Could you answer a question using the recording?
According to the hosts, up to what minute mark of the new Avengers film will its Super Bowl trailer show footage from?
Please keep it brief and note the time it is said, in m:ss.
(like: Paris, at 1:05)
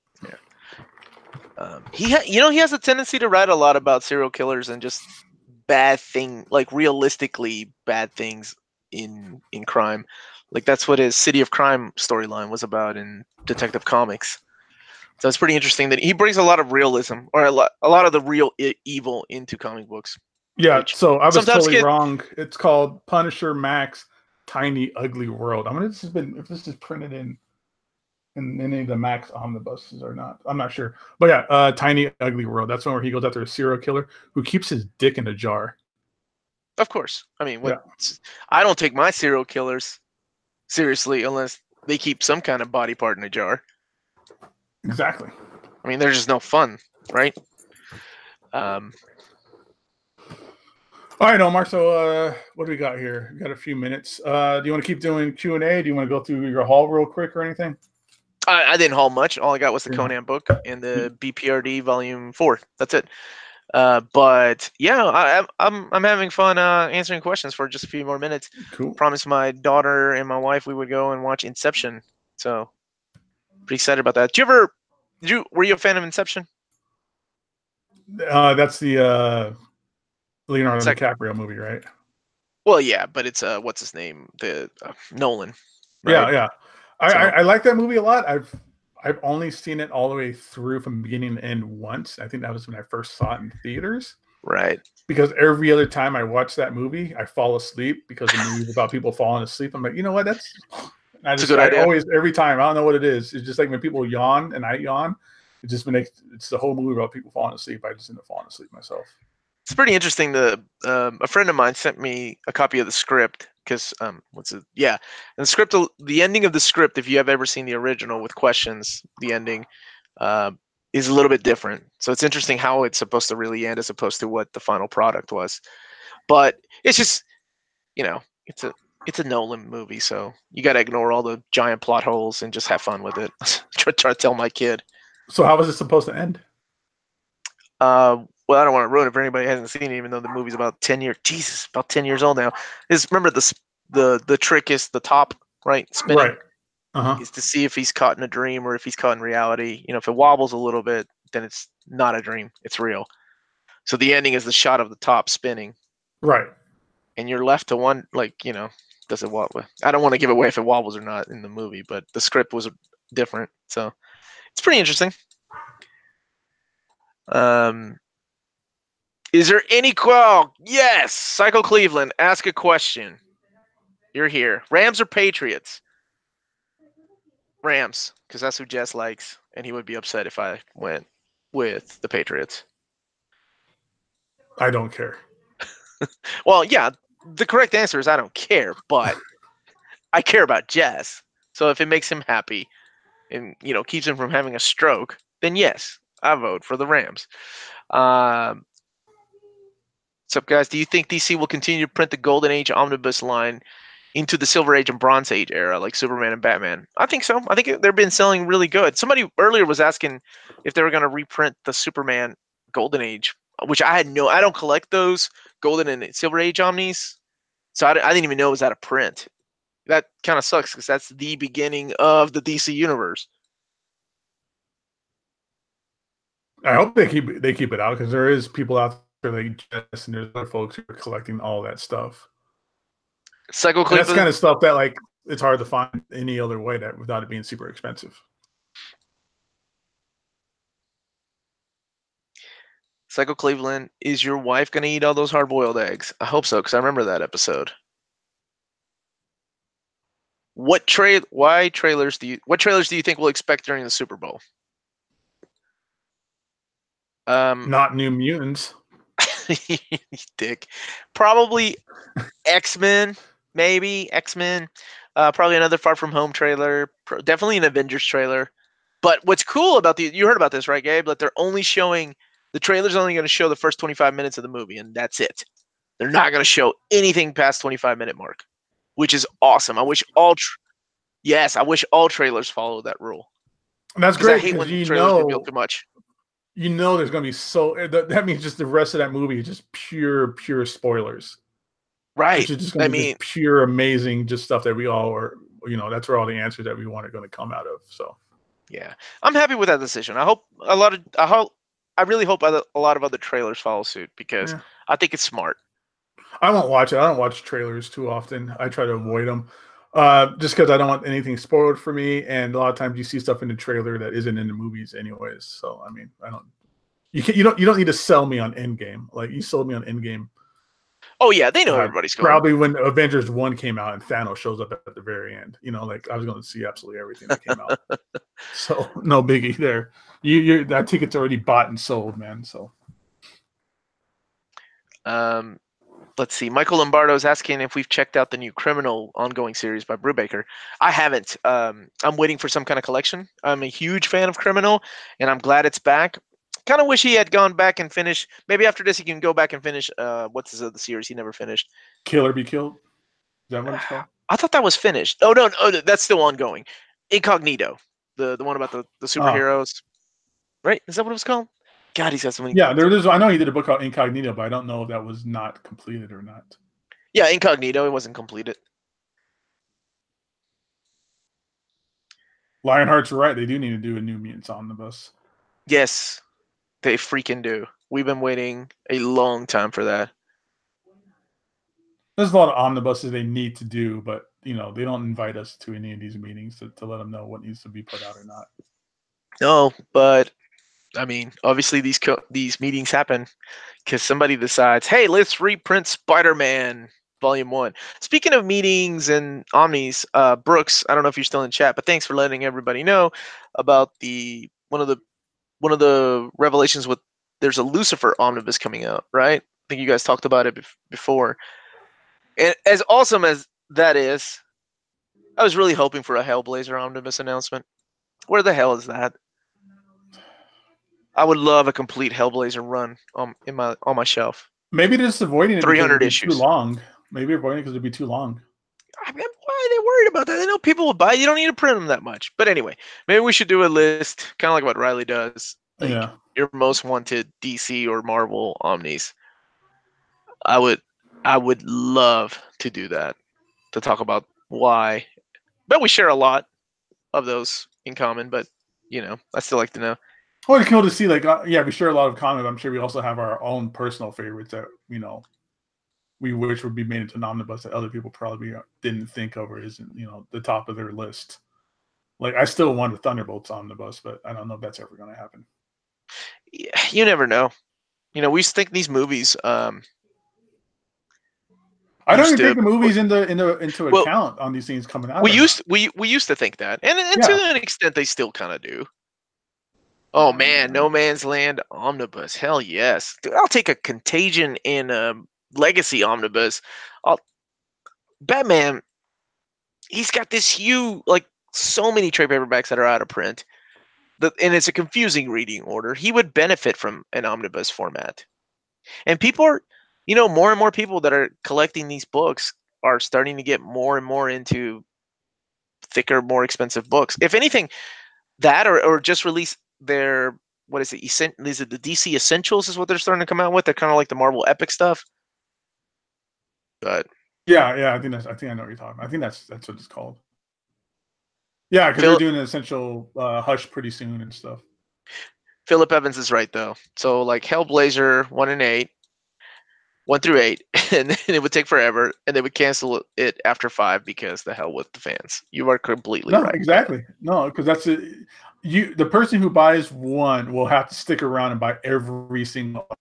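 25 minutes, at 4:37.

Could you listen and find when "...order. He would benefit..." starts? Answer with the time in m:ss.
8:15.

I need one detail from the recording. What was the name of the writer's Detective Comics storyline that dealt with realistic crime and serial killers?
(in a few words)
City of Crime.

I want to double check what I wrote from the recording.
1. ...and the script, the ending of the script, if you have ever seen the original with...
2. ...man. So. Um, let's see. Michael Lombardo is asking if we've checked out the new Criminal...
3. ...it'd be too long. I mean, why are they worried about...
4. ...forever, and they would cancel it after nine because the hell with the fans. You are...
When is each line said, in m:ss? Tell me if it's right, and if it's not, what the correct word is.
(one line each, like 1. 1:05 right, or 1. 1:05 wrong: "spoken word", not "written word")
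1. 1:54 right
2. 5:32 right
3. 7:07 right
4. 8:51 wrong: "five", not "nine".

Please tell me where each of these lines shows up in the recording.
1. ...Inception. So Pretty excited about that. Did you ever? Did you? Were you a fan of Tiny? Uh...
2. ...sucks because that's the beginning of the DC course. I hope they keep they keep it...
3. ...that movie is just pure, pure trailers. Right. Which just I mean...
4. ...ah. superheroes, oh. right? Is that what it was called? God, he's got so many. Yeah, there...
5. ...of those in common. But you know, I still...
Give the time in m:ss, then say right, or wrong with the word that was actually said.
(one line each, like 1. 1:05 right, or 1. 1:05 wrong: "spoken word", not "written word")
1. 1:11 wrong: "Inception", not "Tiny"
2. 3:40 wrong: "universe", not "course"
3. 4:48 wrong: "spoilers", not "trailers"
4. 5:59 right
5. 7:27 right.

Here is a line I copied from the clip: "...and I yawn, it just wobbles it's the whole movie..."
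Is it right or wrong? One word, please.
wrong.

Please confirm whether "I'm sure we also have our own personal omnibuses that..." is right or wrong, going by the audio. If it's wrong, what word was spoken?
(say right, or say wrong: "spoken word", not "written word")
wrong: "favorites", not "omnibuses".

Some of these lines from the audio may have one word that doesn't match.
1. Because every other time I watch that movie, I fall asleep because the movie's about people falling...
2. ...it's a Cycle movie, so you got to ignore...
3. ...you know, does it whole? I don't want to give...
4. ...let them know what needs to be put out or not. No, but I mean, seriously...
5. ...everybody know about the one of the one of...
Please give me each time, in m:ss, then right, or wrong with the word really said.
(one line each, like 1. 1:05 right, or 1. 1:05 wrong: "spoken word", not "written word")
1. 1:35 right
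2. 2:09 wrong: "Nolan", not "Cycle"
3. 2:38 wrong: "wobble", not "whole"
4. 6:26 wrong: "obviously", not "seriously"
5. 6:42 right.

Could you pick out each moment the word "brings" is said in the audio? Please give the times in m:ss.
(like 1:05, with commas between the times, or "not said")
0:16.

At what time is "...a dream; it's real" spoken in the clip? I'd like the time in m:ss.
2:32.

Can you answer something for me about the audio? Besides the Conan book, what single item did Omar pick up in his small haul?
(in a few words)
BPRD Volume Four.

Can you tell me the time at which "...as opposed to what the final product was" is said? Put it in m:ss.
2:03.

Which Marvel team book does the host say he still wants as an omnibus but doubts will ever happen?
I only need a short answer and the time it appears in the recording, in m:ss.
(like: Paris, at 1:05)
Thunderbolts, at 7:42.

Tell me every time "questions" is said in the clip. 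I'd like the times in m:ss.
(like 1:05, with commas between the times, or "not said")
1:07, 1:58, 2:52.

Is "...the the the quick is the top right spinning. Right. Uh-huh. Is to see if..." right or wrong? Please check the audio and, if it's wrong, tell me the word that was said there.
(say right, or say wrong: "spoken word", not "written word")
wrong: "trick", not "quick".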